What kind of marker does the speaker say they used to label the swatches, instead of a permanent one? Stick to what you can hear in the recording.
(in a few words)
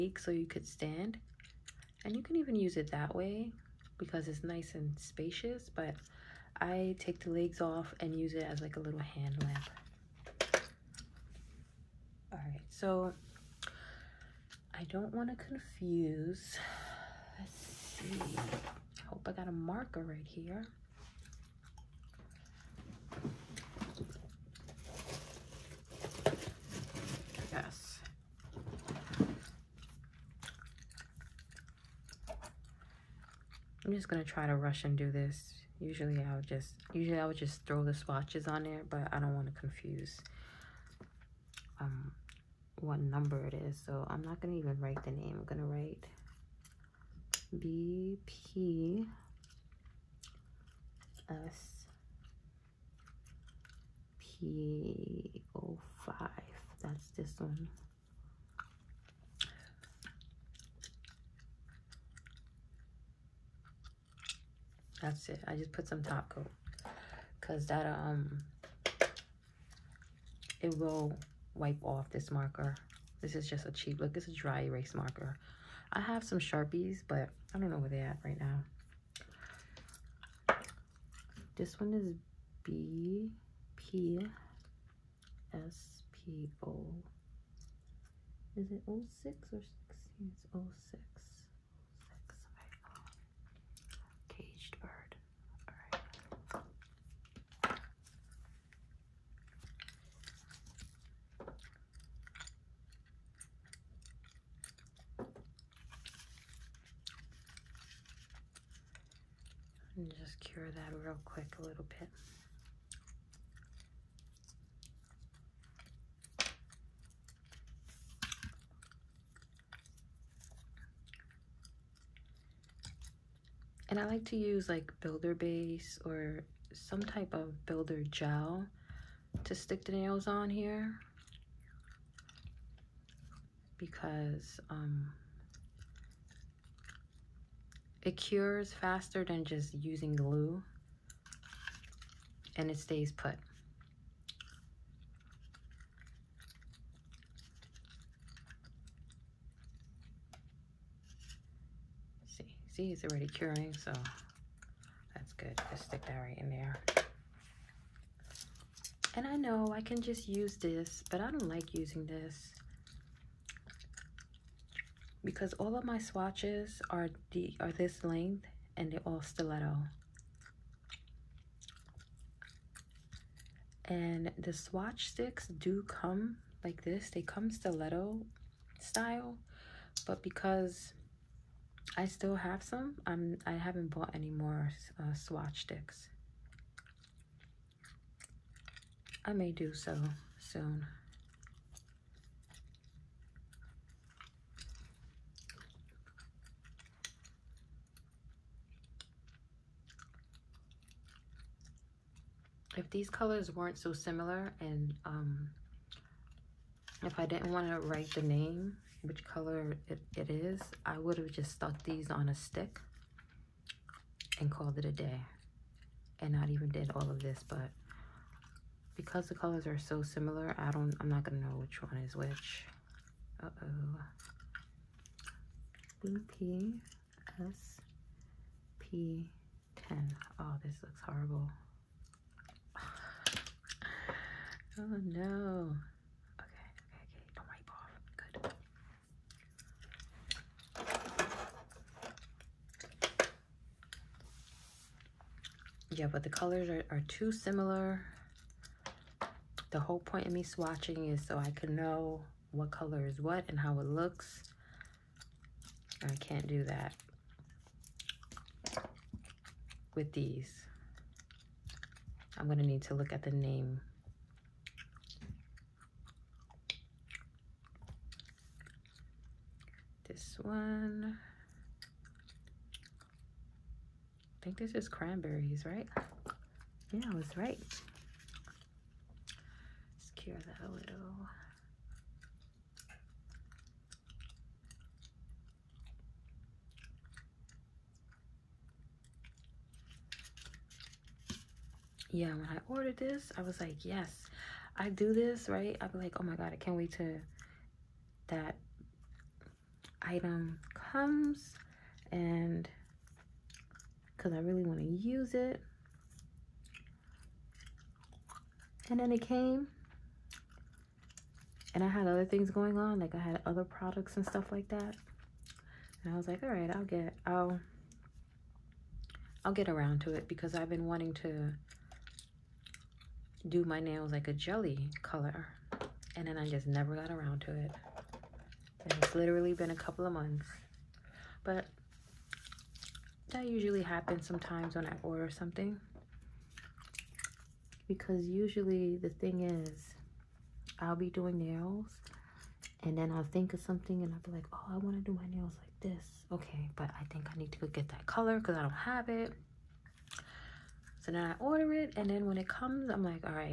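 Dry erase marker.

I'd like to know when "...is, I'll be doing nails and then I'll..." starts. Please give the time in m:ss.
5:39.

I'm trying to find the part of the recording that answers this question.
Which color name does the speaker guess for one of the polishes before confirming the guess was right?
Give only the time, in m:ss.
4:34.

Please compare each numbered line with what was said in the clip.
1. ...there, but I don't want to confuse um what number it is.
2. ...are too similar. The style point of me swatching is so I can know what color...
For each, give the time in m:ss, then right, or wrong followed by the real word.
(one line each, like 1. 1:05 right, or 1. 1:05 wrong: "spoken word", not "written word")
1. 0:38 right
2. 4:06 wrong: "whole", not "style".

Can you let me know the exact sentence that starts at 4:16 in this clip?
I can't do that with these.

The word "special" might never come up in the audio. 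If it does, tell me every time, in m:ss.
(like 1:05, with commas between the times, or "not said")
not said.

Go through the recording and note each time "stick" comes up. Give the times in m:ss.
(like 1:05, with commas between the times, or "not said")
2:09, 2:35, 2:55, 3:05, 3:32.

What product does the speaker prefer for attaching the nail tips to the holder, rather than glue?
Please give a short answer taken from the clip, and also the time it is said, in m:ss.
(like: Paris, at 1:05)
Builder gel, at 2:07.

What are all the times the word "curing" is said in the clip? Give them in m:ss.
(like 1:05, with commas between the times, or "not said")
2:33.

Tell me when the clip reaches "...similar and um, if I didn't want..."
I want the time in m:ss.
3:23.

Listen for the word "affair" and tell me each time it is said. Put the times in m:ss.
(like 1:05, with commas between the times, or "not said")
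not said.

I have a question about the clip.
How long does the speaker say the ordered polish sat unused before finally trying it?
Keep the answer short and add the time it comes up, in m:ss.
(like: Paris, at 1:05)
A couple of months, at 5:29.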